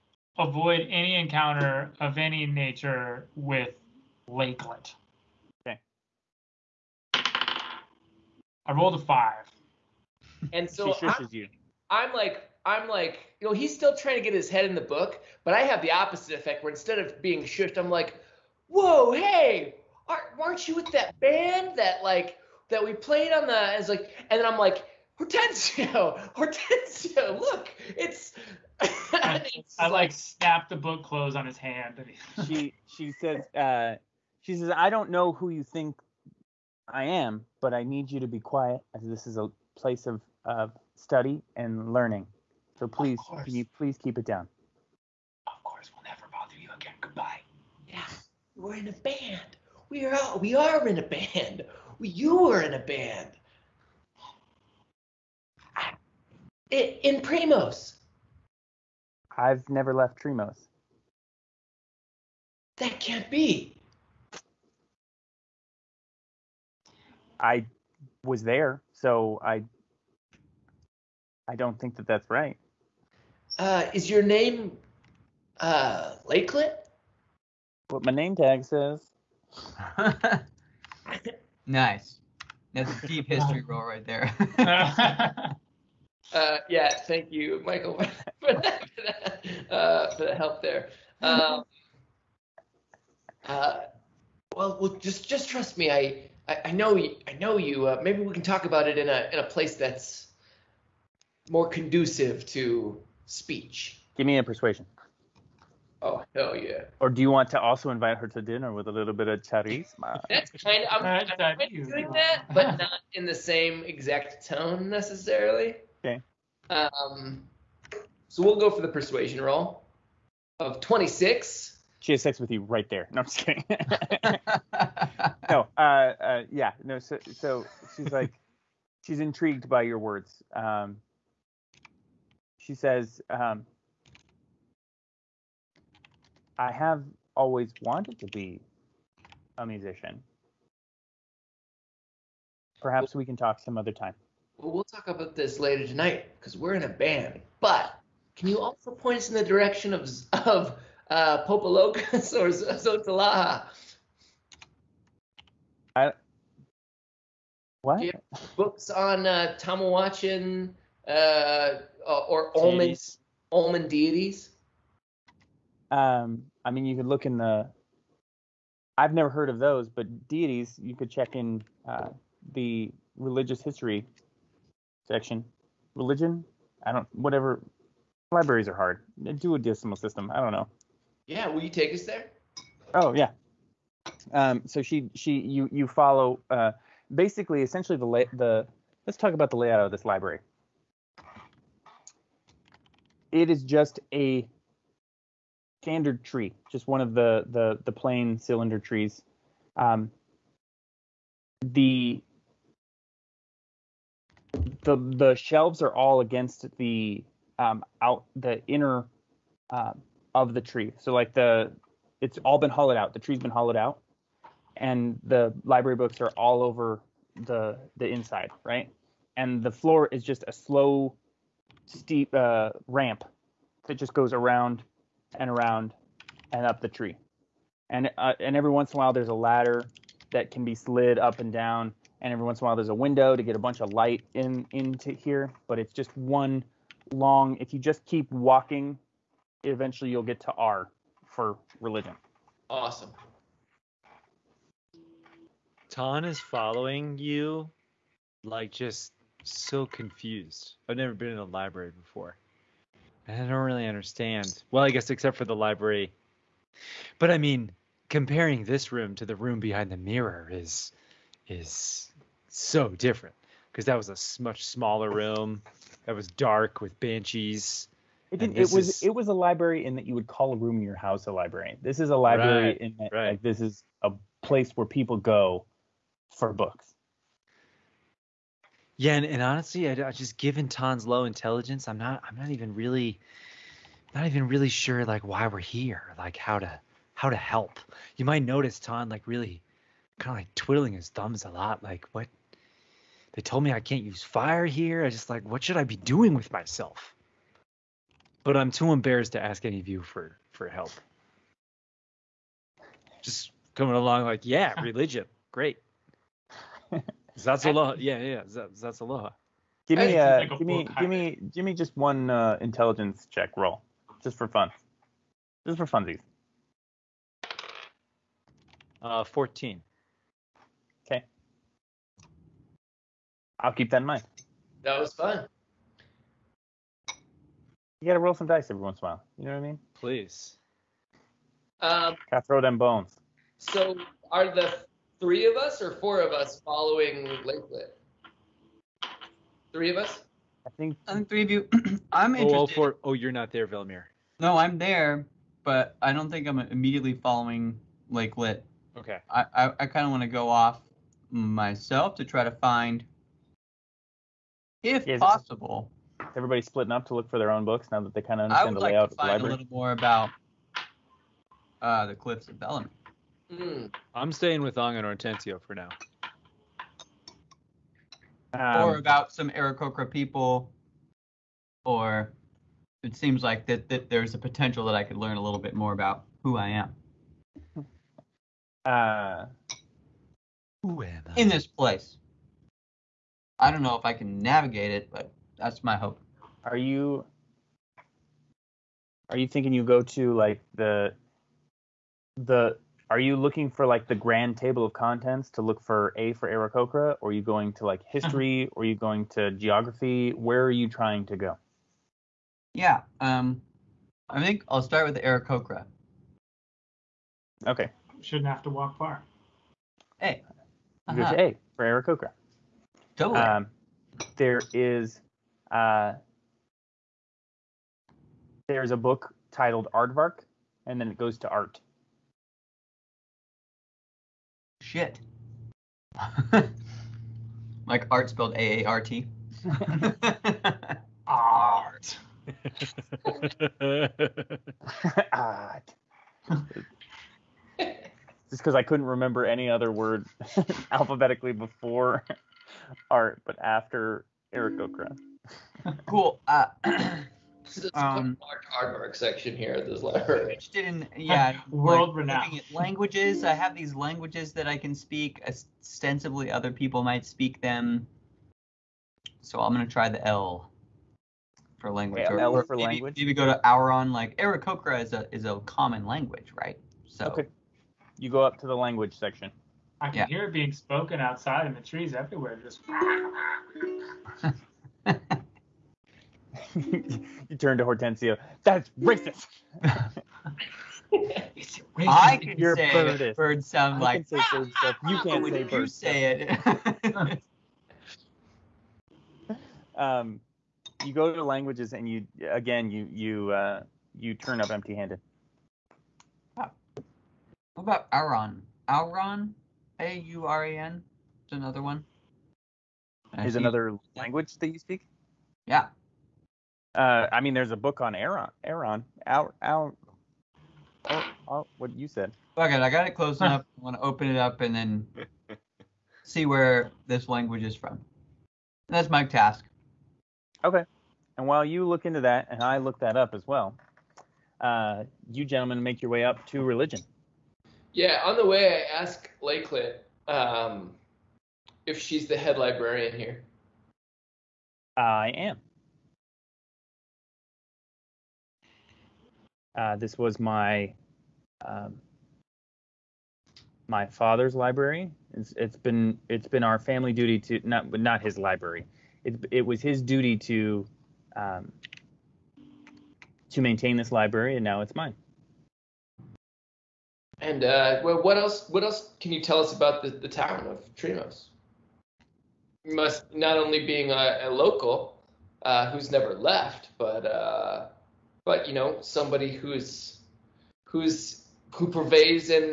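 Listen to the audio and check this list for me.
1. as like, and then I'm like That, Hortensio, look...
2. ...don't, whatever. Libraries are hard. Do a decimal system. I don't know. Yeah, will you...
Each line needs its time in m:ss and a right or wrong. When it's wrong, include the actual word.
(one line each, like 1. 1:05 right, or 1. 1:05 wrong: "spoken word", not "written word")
1. 0:23 wrong: "Hortensio", not "That"
2. 2:56 right.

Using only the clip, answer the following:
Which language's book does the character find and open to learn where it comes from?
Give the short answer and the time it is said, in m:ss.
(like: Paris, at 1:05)
Auran, at 8:18.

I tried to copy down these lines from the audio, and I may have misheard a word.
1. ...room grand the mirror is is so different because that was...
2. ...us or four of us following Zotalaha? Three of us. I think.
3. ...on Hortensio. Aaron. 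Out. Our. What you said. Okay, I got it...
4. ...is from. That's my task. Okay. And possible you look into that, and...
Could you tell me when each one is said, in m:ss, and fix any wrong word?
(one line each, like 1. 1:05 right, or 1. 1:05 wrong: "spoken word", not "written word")
1. 4:19 wrong: "behind", not "grand"
2. 5:35 wrong: "Lakelet", not "Zotalaha"
3. 8:28 wrong: "Aaron", not "Hortensio"
4. 8:37 wrong: "while", not "possible".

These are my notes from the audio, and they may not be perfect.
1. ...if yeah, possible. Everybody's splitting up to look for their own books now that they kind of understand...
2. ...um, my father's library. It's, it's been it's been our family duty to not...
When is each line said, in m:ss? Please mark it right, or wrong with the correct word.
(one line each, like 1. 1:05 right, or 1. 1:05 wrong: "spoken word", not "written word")
1. 5:54 right
2. 9:01 right.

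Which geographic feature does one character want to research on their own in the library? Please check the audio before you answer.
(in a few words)
Cliffs of Bellamy.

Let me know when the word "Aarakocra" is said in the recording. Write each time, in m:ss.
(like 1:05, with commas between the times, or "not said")
6:09, 6:36, 6:45, 6:51.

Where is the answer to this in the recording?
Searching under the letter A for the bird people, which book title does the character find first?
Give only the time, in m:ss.
6:59.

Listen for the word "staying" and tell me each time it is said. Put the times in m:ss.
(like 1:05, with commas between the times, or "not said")
6:04.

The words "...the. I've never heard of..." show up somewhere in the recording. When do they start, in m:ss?
2:47.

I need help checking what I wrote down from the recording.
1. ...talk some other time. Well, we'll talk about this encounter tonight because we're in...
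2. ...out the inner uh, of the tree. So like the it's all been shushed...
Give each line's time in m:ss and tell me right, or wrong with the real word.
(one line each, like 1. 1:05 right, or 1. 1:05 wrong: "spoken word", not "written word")
1. 2:23 wrong: "later", not "encounter"
2. 3:28 wrong: "hollowed", not "shushed".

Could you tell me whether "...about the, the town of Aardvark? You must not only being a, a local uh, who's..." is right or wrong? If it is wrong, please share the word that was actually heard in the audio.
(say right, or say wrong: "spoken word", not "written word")
wrong: "Triemos", not "Aardvark".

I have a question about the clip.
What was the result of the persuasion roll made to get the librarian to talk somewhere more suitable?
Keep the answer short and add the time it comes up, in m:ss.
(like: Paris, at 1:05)
26, at 2:00.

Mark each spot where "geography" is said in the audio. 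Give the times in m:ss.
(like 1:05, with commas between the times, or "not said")
6:39.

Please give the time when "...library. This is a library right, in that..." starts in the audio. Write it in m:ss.
4:31.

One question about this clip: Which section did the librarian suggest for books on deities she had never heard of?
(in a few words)
Religious history section.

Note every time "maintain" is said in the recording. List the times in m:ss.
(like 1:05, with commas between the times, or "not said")
9:13.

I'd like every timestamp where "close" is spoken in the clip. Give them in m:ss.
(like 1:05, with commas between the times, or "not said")
0:31, 8:33.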